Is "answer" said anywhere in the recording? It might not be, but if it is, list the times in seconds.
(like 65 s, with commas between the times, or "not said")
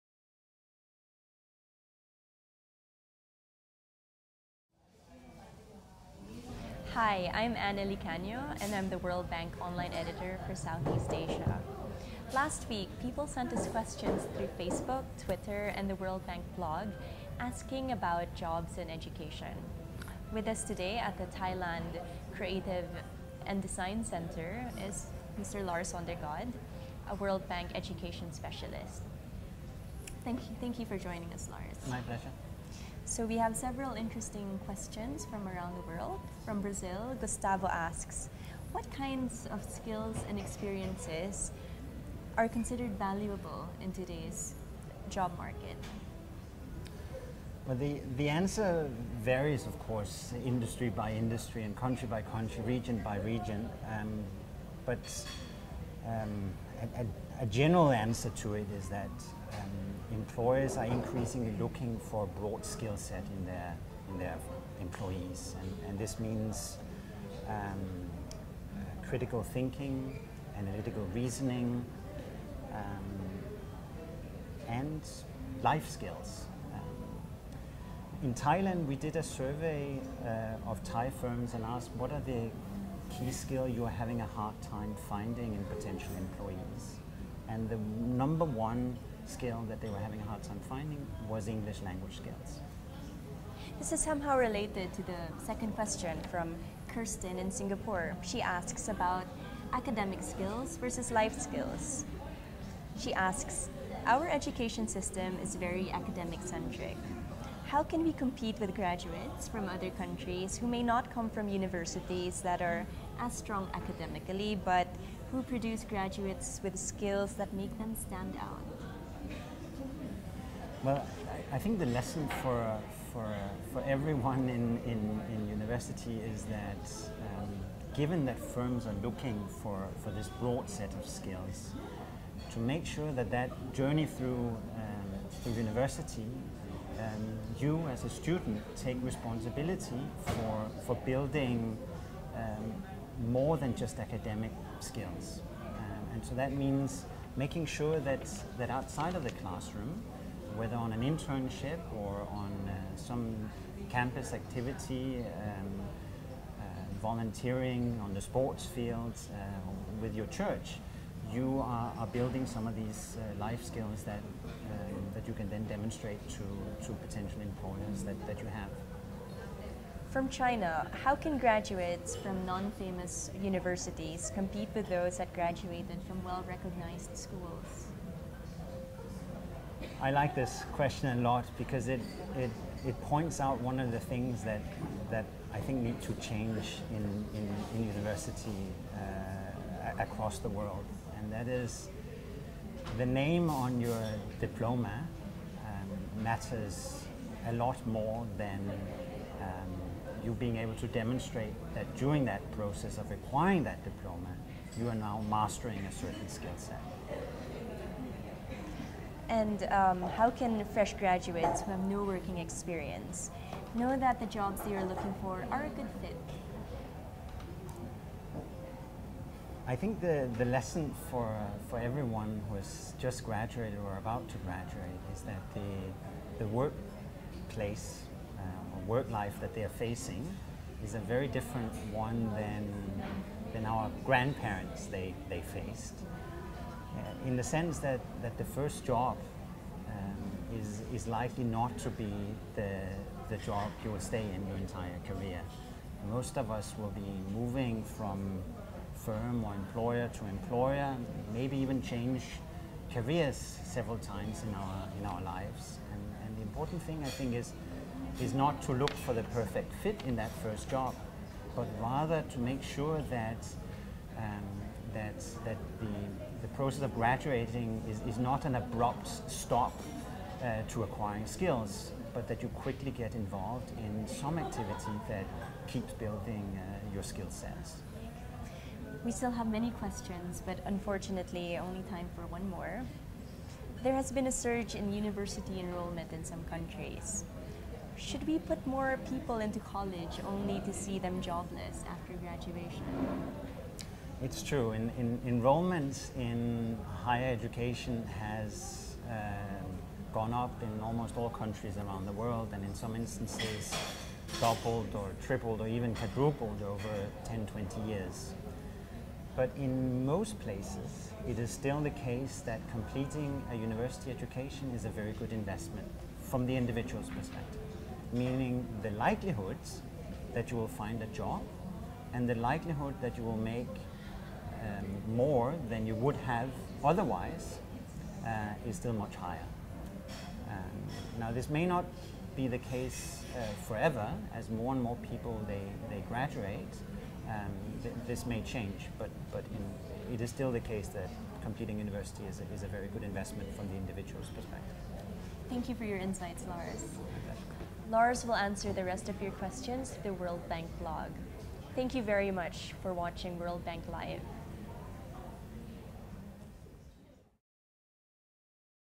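48 s, 57 s, 348 s.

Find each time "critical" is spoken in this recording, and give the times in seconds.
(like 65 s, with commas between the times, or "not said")
69 s.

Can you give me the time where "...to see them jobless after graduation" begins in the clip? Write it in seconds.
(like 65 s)
290 s.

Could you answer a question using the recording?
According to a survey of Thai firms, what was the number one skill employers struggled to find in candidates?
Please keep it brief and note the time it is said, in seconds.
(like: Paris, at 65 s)
English language skills, at 91 s.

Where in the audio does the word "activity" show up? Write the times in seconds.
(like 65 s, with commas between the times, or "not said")
154 s, 274 s.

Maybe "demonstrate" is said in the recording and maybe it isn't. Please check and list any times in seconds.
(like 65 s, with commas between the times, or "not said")
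165 s, 200 s.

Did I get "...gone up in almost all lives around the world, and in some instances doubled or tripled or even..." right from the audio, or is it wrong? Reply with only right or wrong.
wrong.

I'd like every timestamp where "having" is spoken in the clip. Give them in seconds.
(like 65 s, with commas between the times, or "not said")
83 s, 89 s.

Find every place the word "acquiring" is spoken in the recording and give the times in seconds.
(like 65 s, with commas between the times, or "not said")
203 s, 270 s.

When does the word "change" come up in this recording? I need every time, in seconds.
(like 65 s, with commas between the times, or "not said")
186 s, 251 s, 338 s.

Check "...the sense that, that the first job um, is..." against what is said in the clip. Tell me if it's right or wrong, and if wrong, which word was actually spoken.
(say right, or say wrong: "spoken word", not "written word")
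right.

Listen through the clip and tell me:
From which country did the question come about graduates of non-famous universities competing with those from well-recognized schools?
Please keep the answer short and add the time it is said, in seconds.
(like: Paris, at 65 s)
China, at 170 s.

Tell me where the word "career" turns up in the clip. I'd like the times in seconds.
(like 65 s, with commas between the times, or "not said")
245 s, 252 s.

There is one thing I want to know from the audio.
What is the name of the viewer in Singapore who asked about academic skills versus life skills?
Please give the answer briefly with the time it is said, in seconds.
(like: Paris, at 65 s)
Kirsten, at 96 s.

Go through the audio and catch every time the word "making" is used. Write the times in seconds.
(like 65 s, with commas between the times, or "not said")
147 s.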